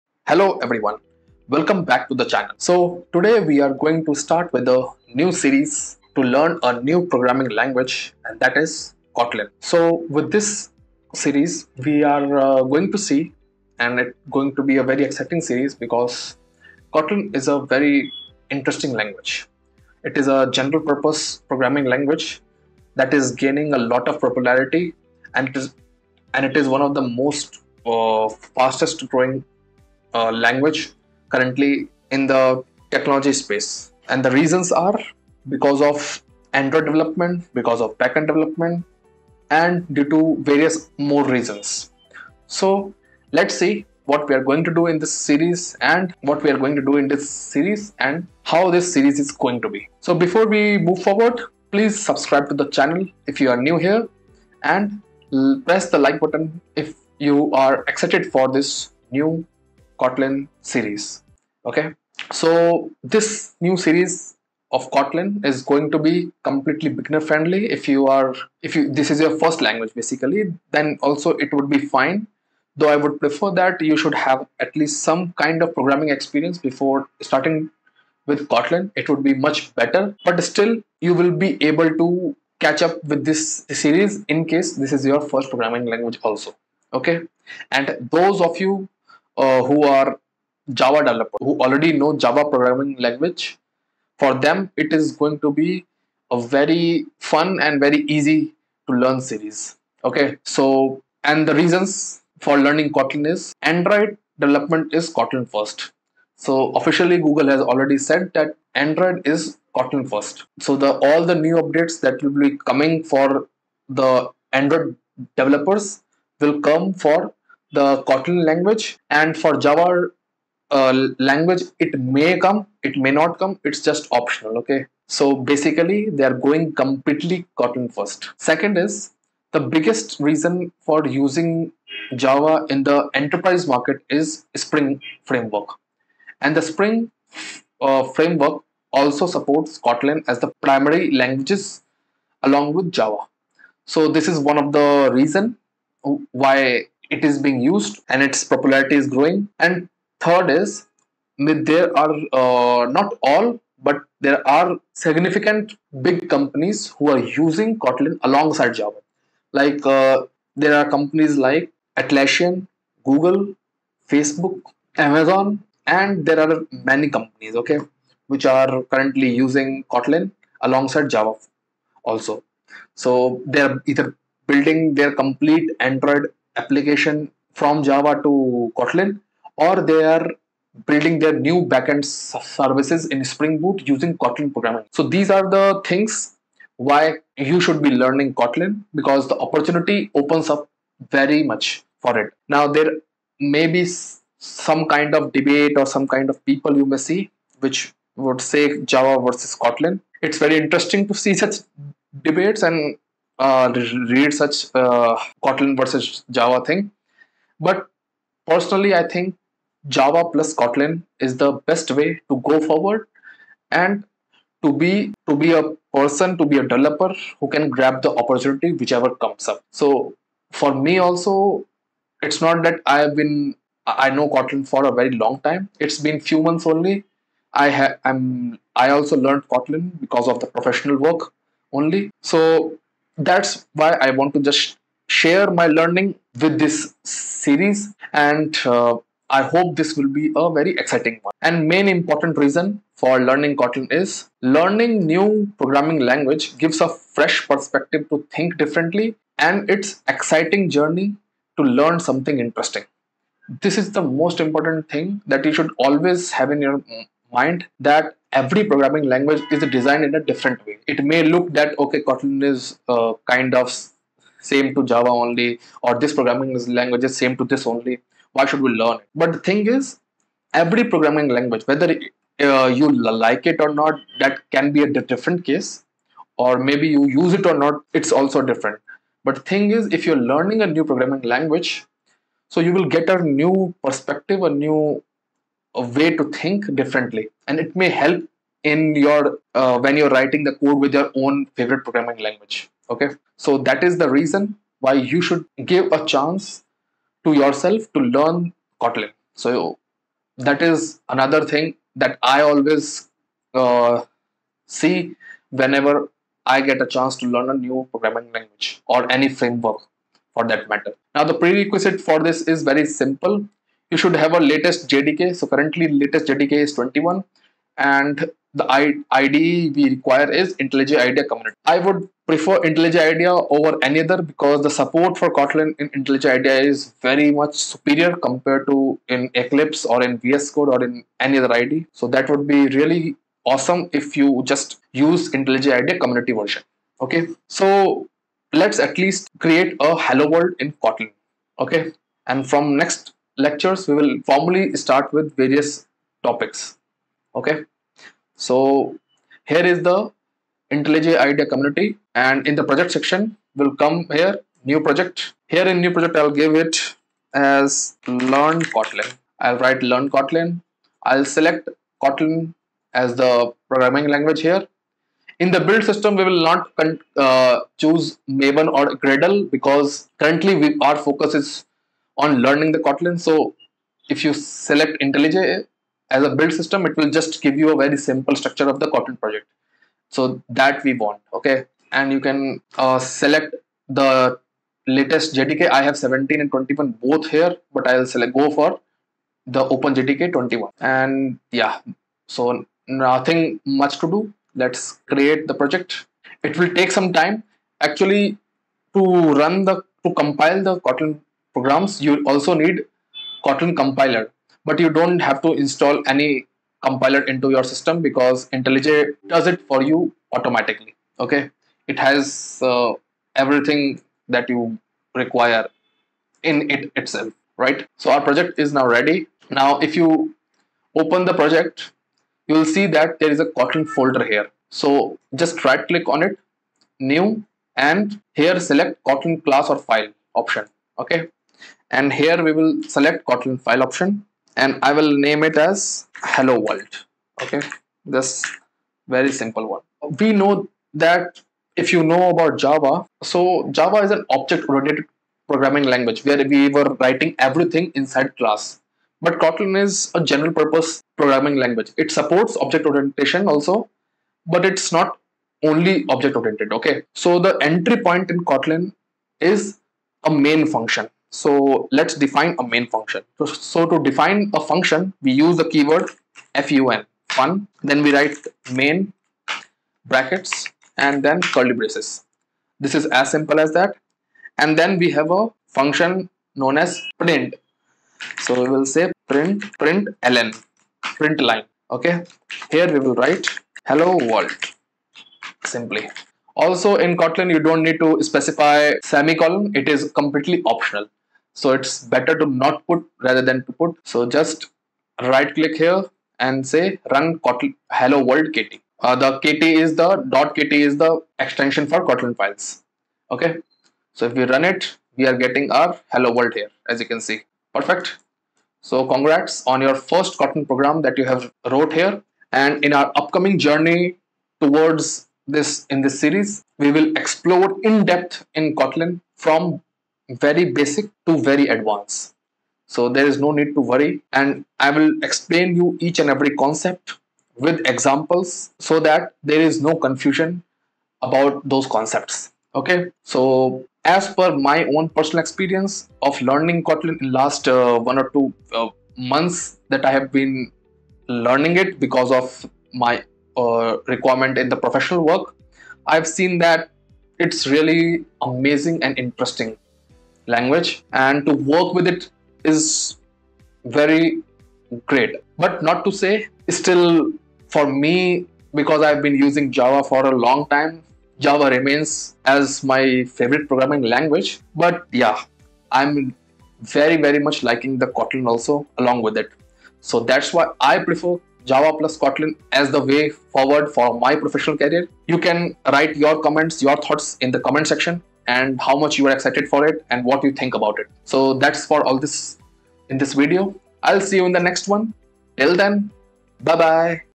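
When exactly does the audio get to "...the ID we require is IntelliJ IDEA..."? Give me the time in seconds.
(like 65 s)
318 s.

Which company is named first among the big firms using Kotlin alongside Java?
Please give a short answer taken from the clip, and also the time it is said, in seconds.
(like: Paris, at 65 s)
Atlassian, at 162 s.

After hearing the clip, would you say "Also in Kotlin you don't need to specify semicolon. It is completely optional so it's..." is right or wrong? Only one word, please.
right.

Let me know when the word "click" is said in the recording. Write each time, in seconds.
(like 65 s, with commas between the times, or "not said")
425 s, 495 s.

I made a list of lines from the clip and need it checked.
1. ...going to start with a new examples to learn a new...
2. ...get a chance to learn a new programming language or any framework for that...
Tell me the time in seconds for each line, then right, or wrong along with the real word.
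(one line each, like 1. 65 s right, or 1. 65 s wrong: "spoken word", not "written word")
1. 3 s wrong: "series", not "examples"
2. 306 s right.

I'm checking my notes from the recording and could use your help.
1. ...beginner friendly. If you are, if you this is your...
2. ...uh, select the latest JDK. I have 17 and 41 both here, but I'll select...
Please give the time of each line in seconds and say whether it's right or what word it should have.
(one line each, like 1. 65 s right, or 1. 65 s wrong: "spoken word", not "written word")
1. 66 s right
2. 382 s wrong: "21", not "41".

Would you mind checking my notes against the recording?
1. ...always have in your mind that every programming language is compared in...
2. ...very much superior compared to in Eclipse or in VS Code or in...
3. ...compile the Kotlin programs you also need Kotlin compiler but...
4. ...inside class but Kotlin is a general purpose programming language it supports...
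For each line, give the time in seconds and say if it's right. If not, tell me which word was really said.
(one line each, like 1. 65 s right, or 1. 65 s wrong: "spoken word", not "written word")
1. 255 s wrong: "designed", not "compared"
2. 327 s right
3. 400 s right
4. 447 s right.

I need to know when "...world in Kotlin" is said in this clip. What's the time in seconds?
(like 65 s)
340 s.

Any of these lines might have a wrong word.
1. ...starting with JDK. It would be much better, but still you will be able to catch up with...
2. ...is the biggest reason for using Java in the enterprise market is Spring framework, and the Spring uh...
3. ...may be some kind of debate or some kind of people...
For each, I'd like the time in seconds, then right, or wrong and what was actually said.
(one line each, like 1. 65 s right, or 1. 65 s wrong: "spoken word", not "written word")
1. 77 s wrong: "Kotlin", not "JDK"
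2. 128 s right
3. 193 s right.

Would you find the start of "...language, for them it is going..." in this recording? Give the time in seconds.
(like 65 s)
92 s.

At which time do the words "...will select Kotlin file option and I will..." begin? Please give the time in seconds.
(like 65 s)
432 s.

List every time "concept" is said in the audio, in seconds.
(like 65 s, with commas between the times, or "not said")
526 s, 531 s.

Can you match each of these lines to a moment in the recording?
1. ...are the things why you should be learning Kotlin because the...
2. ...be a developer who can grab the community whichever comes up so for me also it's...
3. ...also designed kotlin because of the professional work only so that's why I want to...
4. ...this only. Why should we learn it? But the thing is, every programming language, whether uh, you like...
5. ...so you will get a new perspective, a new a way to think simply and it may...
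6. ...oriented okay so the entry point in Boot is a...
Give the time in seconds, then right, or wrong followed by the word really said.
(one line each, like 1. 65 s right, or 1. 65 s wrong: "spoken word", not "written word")
1. 185 s right
2. 216 s wrong: "opportunity", not "community"
3. 228 s wrong: "learned", not "designed"
4. 267 s right
5. 282 s wrong: "differently", not "simply"
6. 456 s wrong: "Kotlin", not "Boot".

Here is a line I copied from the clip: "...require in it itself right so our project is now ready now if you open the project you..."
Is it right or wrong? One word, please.
right.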